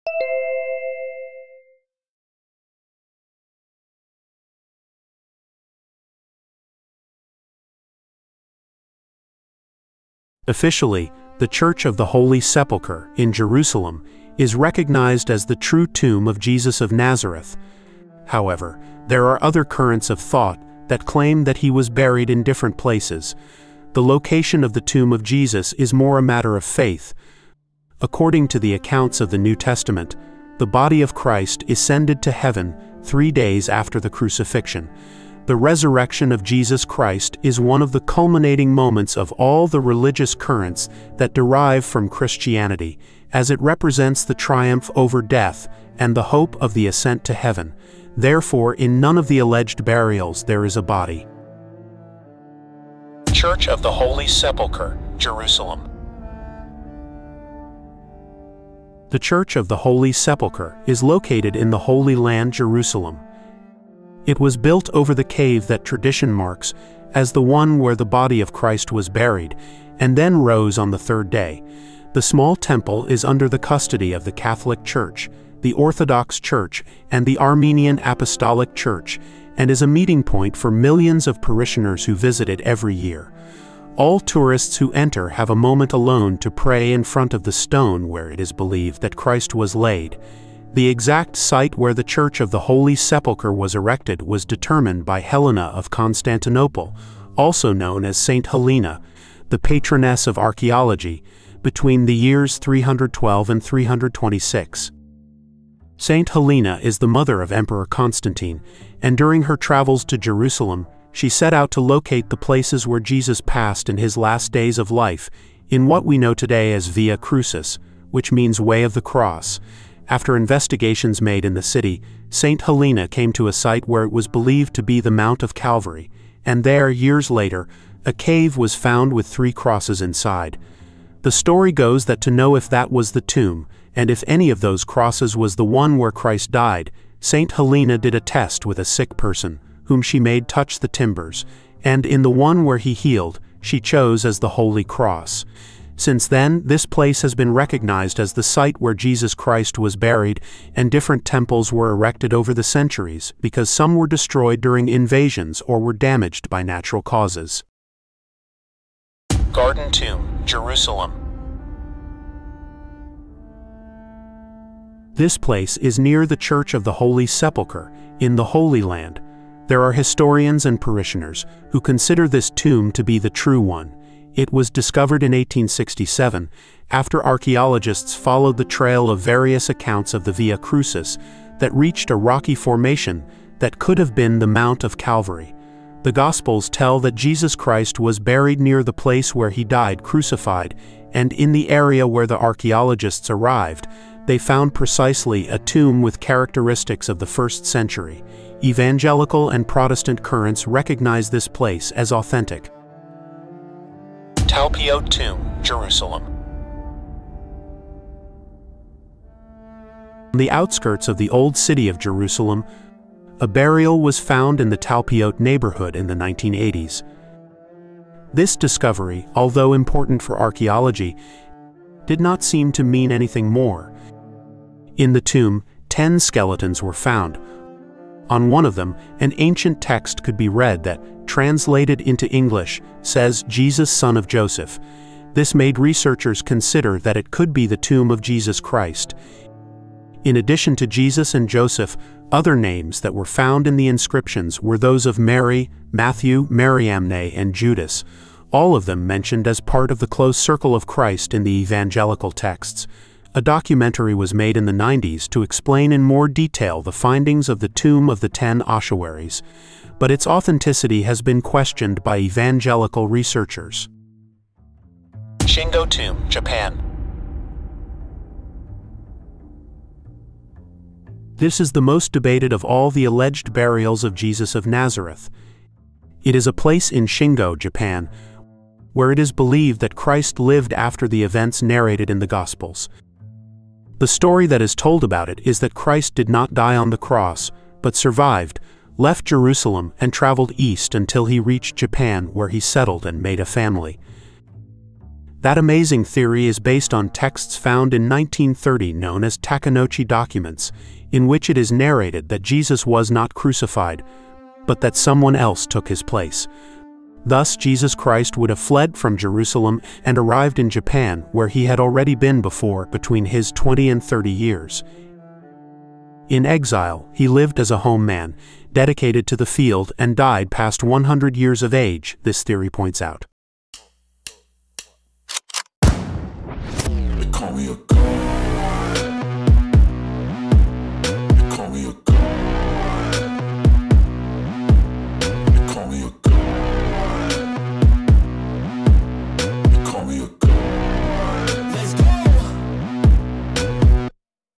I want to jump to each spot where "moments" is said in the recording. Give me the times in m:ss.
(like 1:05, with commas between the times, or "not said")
0:38, 1:25.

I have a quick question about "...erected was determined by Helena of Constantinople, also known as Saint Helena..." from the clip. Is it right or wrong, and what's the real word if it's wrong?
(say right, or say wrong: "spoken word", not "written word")
right.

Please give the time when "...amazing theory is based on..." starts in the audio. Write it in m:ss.
4:55.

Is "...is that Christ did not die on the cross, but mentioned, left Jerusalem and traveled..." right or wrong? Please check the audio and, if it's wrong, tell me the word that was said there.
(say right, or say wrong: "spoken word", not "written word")
wrong: "survived", not "mentioned".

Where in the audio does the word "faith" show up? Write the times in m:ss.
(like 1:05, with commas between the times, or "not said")
0:26.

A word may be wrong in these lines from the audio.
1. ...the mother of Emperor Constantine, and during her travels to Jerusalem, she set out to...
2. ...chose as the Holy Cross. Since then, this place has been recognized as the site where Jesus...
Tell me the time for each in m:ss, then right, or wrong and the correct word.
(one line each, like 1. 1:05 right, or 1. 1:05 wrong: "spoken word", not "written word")
1. 1:46 right
2. 2:23 right.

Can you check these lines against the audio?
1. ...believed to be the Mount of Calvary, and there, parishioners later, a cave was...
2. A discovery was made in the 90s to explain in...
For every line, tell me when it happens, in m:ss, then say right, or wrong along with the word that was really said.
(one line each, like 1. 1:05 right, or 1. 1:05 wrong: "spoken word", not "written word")
1. 2:04 wrong: "years", not "parishioners"
2. 4:13 wrong: "documentary", not "discovery".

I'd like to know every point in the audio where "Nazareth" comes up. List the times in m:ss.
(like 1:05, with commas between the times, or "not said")
0:16, 4:34.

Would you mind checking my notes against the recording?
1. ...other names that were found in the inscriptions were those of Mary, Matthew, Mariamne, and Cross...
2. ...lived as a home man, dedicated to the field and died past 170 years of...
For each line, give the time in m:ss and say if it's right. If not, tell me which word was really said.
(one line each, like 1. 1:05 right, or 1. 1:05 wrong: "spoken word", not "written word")
1. 4:02 wrong: "Judas", not "Cross"
2. 5:17 wrong: "100", not "170".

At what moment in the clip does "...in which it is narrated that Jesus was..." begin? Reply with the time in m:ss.
5:01.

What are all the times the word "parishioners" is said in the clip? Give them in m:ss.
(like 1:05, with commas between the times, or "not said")
1:21, 2:50.